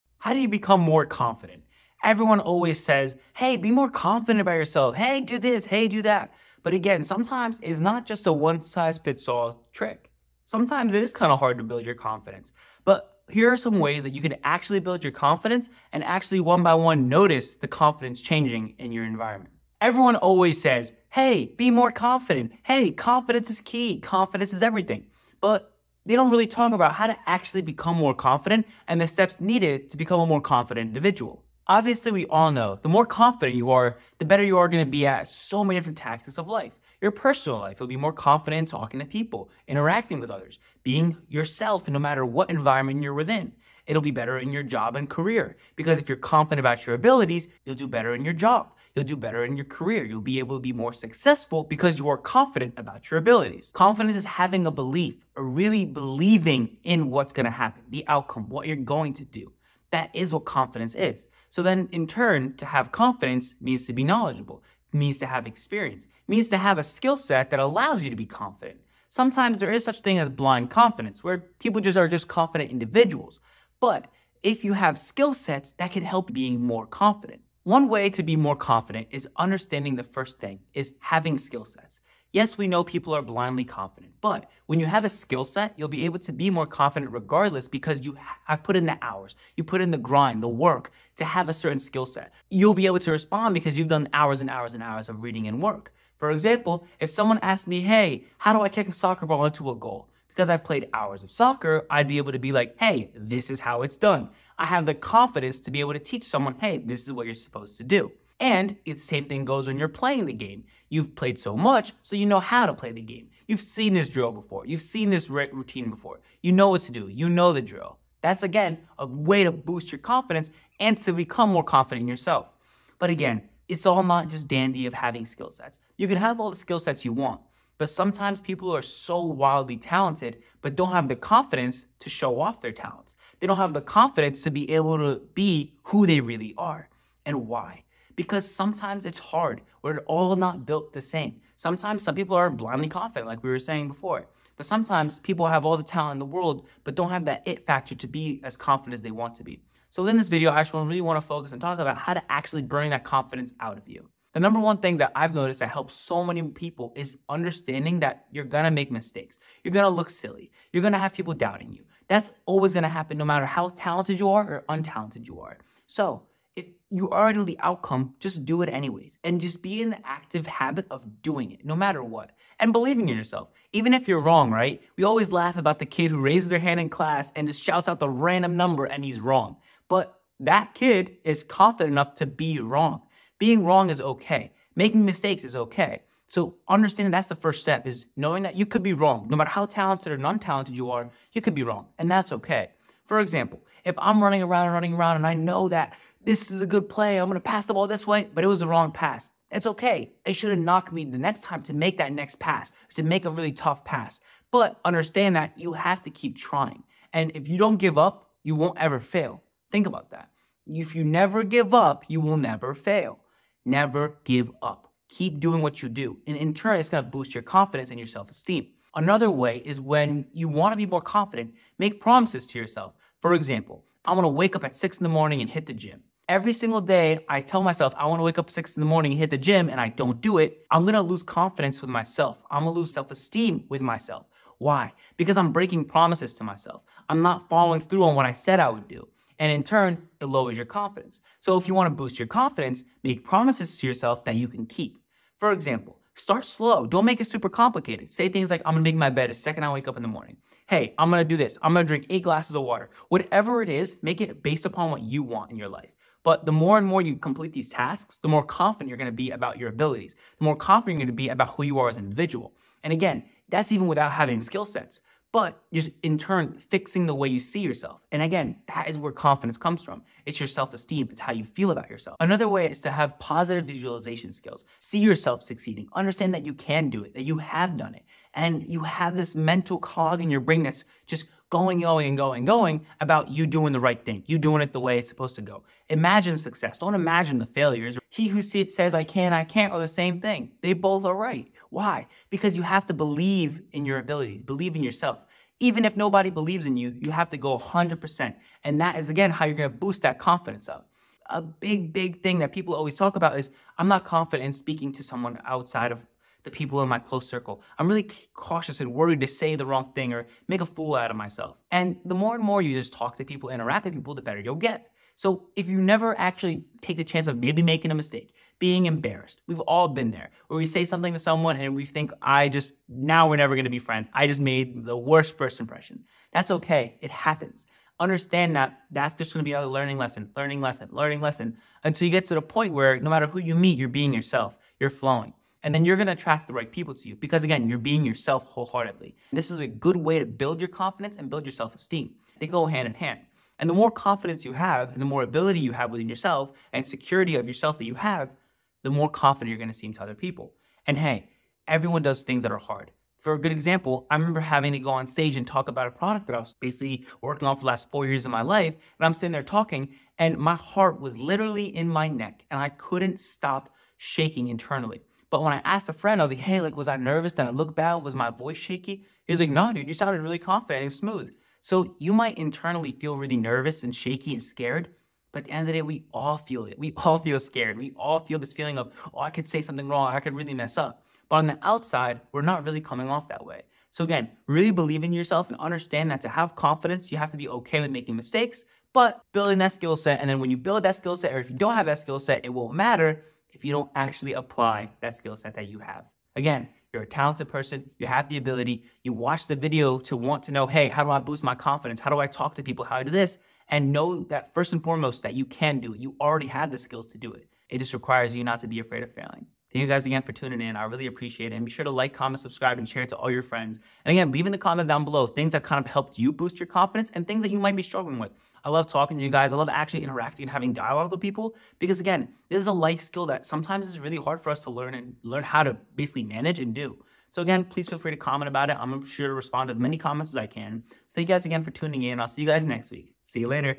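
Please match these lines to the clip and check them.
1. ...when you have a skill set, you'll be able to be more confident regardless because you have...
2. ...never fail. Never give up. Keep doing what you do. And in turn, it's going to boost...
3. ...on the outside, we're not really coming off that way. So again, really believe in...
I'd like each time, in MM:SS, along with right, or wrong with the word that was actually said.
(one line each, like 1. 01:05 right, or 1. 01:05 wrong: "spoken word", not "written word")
1. 01:24 right
2. 03:32 right
3. 06:21 right.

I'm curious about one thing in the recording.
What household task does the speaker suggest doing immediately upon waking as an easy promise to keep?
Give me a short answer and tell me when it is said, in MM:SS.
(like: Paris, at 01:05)
make my bed, at 04:08.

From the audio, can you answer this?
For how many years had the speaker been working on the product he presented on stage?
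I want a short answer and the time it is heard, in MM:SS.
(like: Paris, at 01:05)
4 years, at 05:57.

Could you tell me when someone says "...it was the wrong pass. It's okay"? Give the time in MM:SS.
03:18.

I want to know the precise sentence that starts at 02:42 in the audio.
That's always gonna happen no matter how talented you are or untalented you are.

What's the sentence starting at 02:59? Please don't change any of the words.
But that kid is confident enough to be wrong.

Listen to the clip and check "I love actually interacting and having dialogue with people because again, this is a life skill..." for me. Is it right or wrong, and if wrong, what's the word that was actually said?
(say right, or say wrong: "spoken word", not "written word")
right.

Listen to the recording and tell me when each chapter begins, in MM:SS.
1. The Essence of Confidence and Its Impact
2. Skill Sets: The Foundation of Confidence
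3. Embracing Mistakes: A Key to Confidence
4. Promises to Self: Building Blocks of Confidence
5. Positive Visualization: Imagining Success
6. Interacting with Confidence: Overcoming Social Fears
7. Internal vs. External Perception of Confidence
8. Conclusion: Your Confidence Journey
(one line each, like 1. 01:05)
1. 00:31
2. 01:17
3. 02:34
4. 03:38
5. 04:32
6. 05:01
7. 05:48
8. 06:49.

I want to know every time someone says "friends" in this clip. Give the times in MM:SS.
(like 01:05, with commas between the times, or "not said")
05:23, 06:05, 06:53.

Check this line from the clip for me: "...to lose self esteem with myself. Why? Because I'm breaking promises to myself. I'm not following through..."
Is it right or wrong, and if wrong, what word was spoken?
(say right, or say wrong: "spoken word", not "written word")
right.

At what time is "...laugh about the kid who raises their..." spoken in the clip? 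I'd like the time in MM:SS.
02:55.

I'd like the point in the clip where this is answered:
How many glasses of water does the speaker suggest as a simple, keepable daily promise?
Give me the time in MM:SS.
04:12.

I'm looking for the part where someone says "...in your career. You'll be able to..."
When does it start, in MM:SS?
00:49.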